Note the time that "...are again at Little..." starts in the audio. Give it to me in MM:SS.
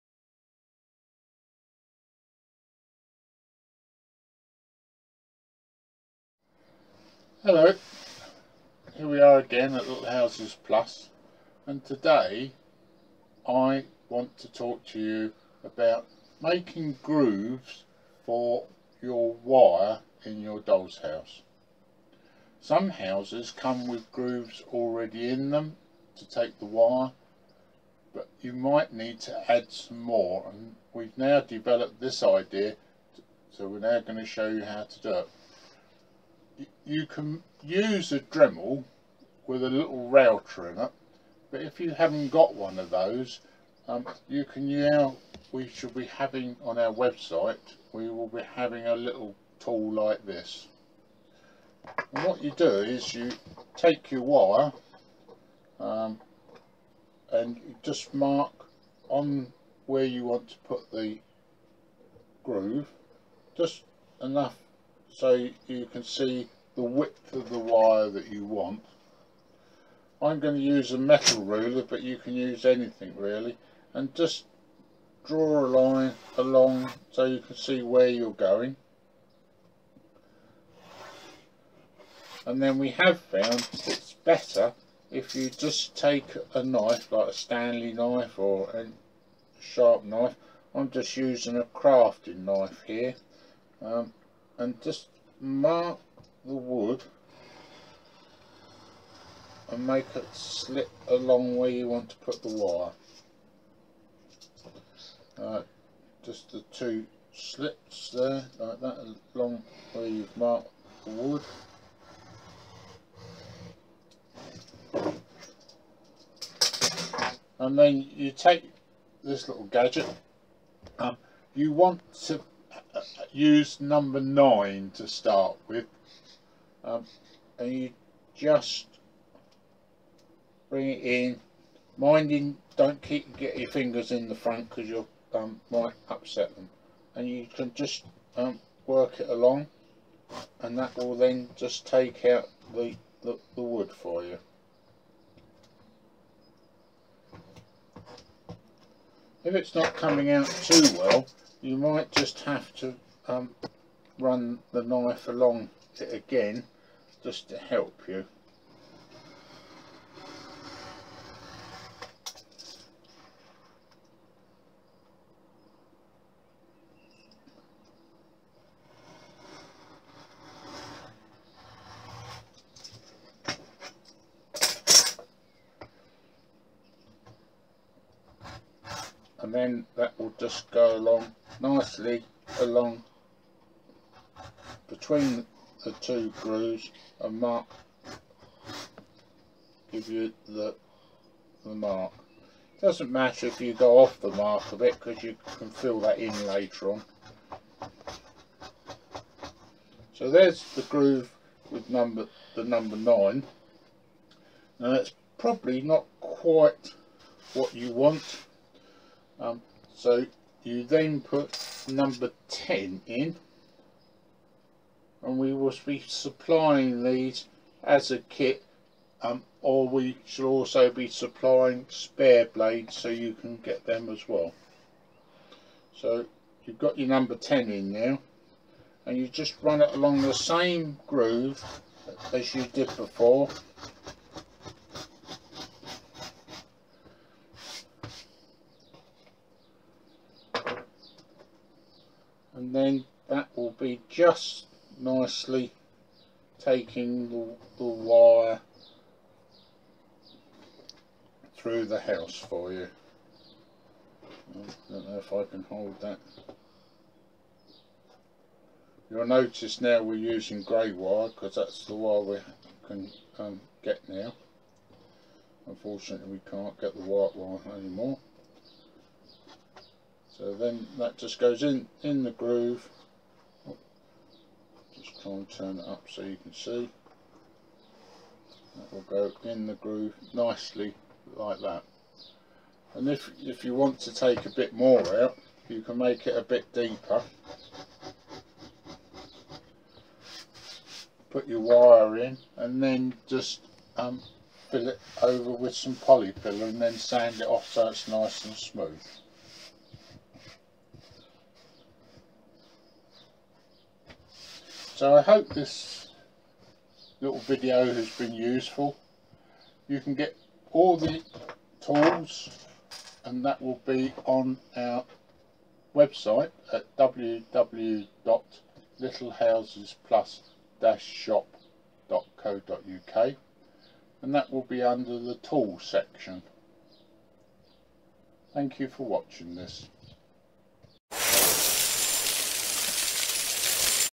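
00:09.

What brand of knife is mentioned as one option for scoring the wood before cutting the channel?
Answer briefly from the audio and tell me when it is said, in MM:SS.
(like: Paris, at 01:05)
Stanley knife, at 01:27.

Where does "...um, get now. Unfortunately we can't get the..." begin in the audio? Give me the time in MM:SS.
04:23.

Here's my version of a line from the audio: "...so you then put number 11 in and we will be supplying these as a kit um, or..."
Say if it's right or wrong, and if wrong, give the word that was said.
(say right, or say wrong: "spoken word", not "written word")
wrong: "10", not "11".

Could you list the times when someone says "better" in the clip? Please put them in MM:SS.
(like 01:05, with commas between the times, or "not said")
01:24.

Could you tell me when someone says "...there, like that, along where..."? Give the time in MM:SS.
01:48.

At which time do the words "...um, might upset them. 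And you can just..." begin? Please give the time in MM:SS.
02:15.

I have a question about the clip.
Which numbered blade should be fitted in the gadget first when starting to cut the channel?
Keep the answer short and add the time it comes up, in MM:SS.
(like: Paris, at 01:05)
9, at 02:03.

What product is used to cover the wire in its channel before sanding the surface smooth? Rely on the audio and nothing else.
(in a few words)
Polyfilla.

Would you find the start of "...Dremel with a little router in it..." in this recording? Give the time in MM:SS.
00:38.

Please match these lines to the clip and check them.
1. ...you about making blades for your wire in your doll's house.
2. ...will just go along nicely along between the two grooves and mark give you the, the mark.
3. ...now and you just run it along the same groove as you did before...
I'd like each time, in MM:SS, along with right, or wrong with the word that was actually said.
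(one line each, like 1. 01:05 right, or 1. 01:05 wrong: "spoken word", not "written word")
1. 00:14 wrong: "grooves", not "blades"
2. 03:00 right
3. 03:47 right.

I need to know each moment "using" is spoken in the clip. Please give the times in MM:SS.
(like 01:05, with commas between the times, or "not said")
01:31, 04:20.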